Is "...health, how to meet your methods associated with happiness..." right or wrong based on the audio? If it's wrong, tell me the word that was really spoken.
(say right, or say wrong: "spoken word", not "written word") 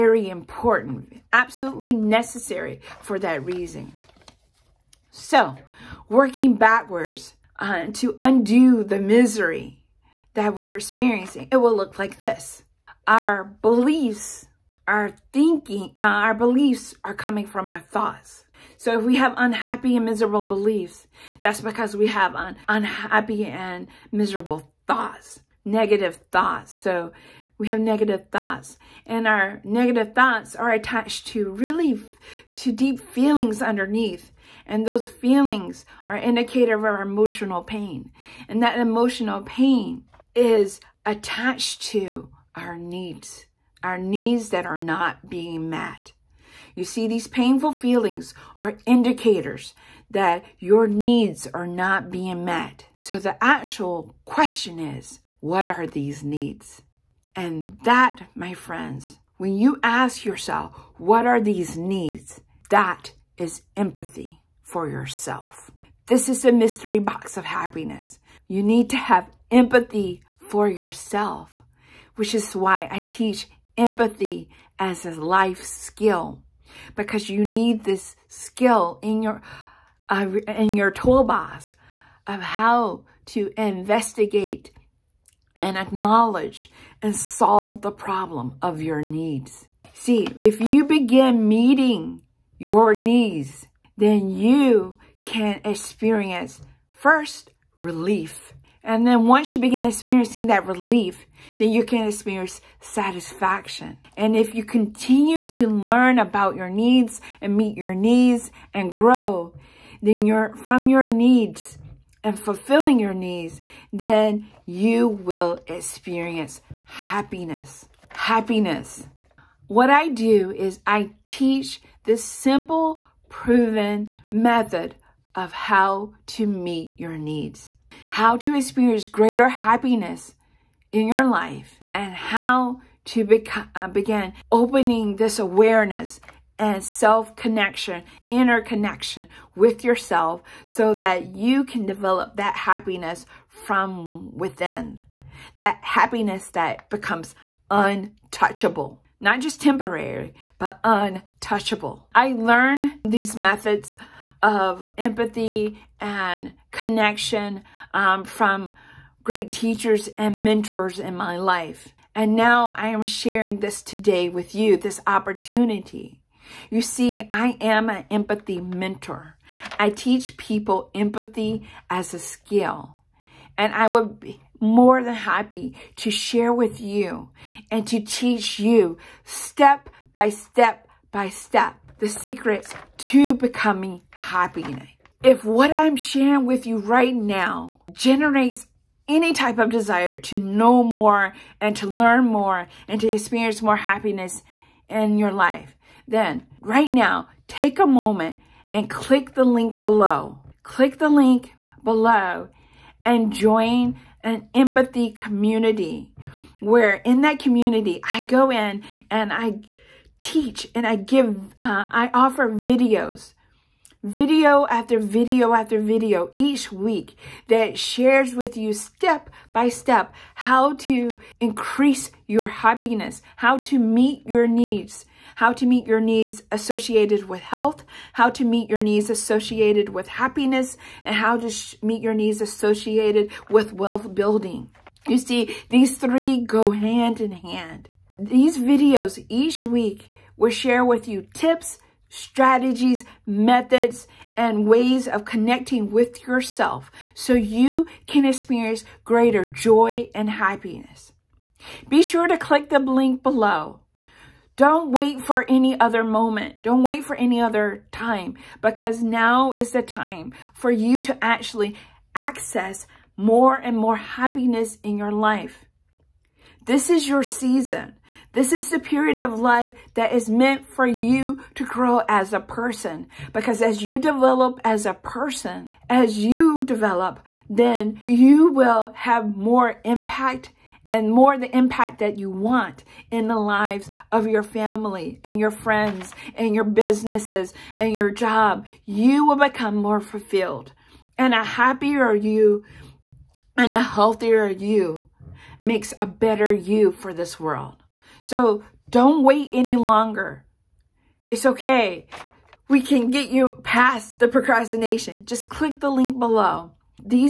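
wrong: "needs", not "methods".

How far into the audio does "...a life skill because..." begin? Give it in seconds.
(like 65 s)
75 s.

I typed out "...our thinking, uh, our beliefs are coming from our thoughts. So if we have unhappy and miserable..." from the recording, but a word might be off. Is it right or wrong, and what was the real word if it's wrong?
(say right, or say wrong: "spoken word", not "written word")
right.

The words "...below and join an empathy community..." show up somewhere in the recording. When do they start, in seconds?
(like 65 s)
201 s.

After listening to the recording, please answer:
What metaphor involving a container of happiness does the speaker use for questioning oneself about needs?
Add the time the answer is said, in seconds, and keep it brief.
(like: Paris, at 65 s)
Mystery box of happiness, at 66 s.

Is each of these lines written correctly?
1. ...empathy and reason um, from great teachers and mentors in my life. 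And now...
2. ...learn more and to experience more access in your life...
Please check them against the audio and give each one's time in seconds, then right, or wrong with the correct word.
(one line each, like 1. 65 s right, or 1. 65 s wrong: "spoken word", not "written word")
1. 154 s wrong: "connection", not "reason"
2. 191 s wrong: "happiness", not "access".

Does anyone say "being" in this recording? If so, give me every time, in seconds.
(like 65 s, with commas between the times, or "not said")
45 s, 52 s.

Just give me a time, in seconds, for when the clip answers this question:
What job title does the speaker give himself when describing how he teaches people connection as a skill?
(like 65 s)
168 s.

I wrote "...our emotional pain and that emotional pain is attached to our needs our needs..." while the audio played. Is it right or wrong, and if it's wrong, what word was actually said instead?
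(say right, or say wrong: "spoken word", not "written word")
right.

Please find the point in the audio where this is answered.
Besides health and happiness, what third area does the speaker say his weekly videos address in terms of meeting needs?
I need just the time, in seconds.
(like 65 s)
233 s.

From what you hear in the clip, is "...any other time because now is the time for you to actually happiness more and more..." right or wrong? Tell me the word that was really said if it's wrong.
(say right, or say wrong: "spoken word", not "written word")
wrong: "access", not "happiness".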